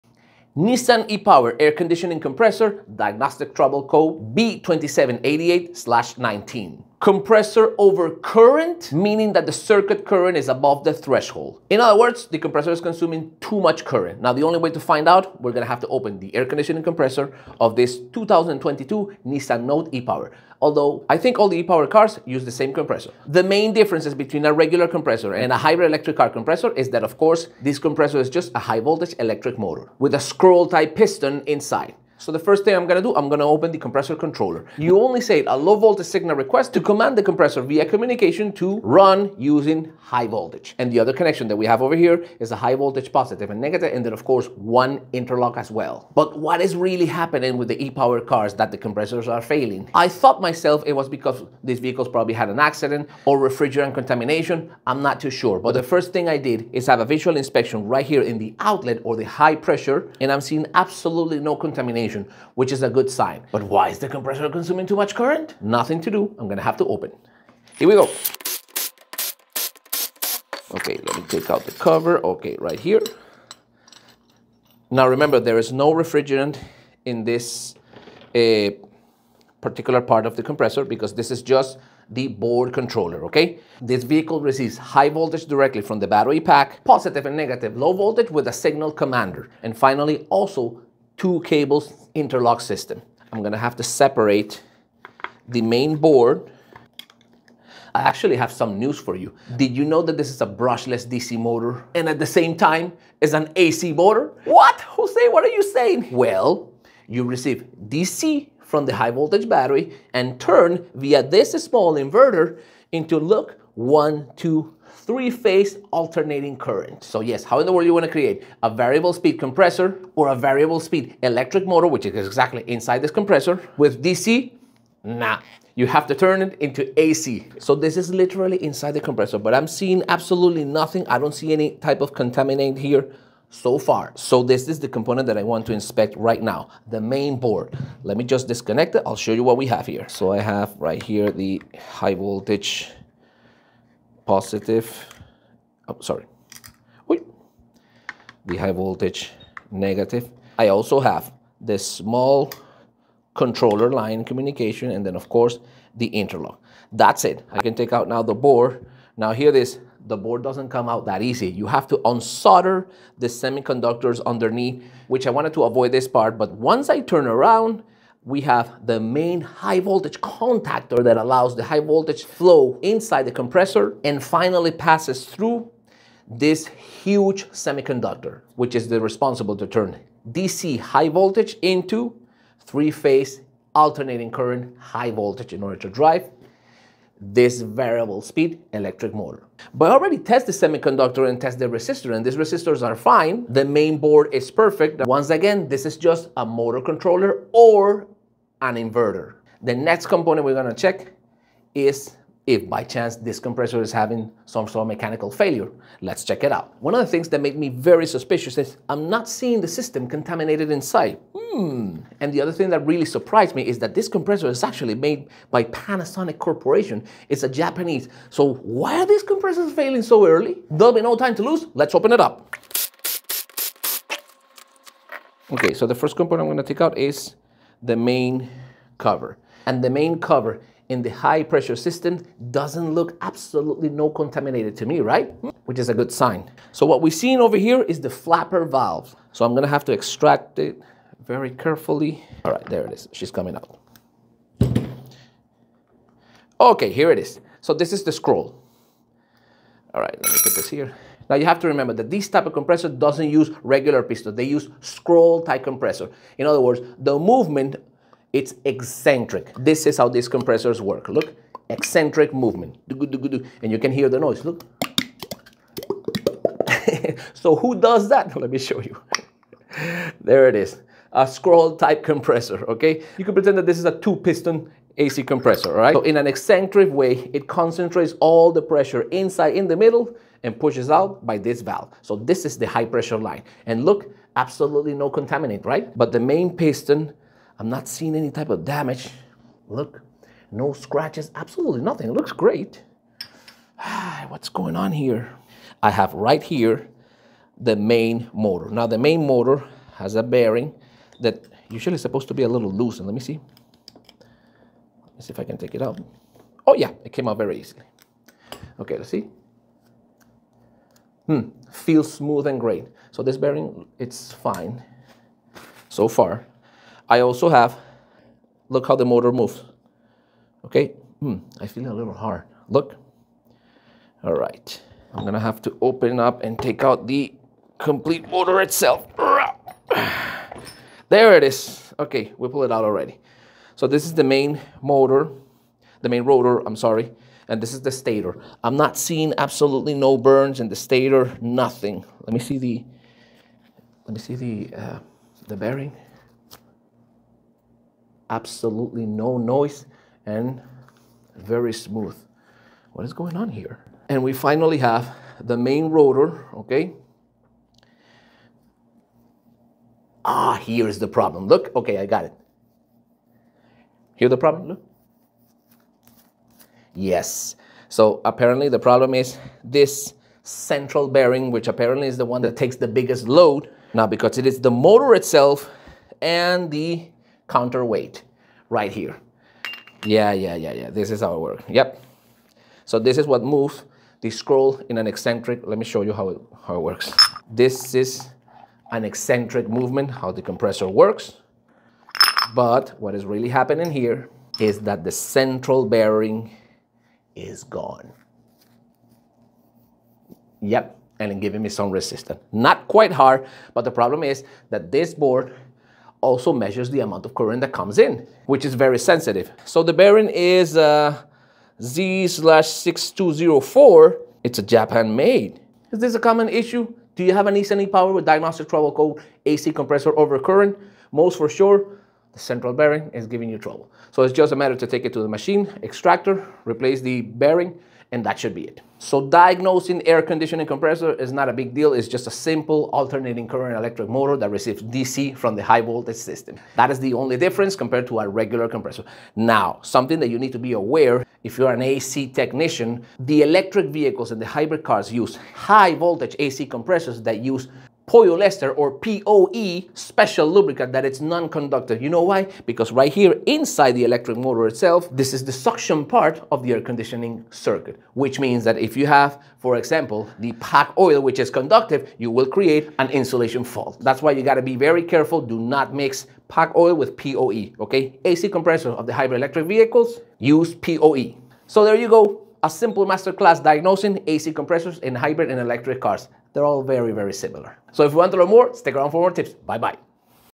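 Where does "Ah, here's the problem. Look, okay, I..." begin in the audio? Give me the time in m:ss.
6:00.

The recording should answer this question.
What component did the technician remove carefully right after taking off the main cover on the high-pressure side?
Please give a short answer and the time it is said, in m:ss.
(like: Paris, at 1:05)
Flapper valve, at 3:58.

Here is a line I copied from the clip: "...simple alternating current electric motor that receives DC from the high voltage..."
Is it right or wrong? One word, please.
right.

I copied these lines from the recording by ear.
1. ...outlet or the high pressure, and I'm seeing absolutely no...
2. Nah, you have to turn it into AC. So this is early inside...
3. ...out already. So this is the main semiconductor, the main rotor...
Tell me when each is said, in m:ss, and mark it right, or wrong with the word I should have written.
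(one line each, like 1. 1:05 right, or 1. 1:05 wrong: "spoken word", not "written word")
1. 0:58 right
2. 2:05 wrong: "literally", not "early"
3. 5:32 wrong: "motor", not "semiconductor".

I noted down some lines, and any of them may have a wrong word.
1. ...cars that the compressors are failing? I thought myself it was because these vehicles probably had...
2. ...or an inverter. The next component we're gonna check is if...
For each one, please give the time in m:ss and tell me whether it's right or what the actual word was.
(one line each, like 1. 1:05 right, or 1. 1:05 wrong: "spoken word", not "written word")
1. 0:48 right
2. 3:17 right.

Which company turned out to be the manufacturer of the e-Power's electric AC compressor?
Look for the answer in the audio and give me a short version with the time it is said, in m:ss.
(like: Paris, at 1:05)
Panasonic Corporation, at 3:35.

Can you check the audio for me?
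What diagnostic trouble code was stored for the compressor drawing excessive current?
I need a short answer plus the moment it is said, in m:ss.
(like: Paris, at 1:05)
B2788-19, at 0:04.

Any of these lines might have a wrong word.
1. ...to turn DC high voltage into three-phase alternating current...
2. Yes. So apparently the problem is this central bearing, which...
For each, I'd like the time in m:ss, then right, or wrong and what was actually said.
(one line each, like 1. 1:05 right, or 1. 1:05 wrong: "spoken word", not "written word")
1. 2:59 right
2. 6:06 right.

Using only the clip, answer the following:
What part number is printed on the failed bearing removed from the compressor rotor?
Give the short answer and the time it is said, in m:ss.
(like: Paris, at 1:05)
Z/6204, at 6:51.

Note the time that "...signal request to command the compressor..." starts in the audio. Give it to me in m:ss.
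0:36.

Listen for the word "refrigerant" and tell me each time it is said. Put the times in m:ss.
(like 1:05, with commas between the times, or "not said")
0:53, 1:15.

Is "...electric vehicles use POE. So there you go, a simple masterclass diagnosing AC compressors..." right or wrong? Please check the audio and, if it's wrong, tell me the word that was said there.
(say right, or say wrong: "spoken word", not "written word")
right.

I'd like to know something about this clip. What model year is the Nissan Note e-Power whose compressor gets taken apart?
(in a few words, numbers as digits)
2022.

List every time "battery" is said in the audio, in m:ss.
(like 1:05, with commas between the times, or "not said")
1:26, 1:49.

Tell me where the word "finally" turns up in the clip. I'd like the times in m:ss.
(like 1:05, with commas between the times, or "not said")
1:29, 2:54, 5:54.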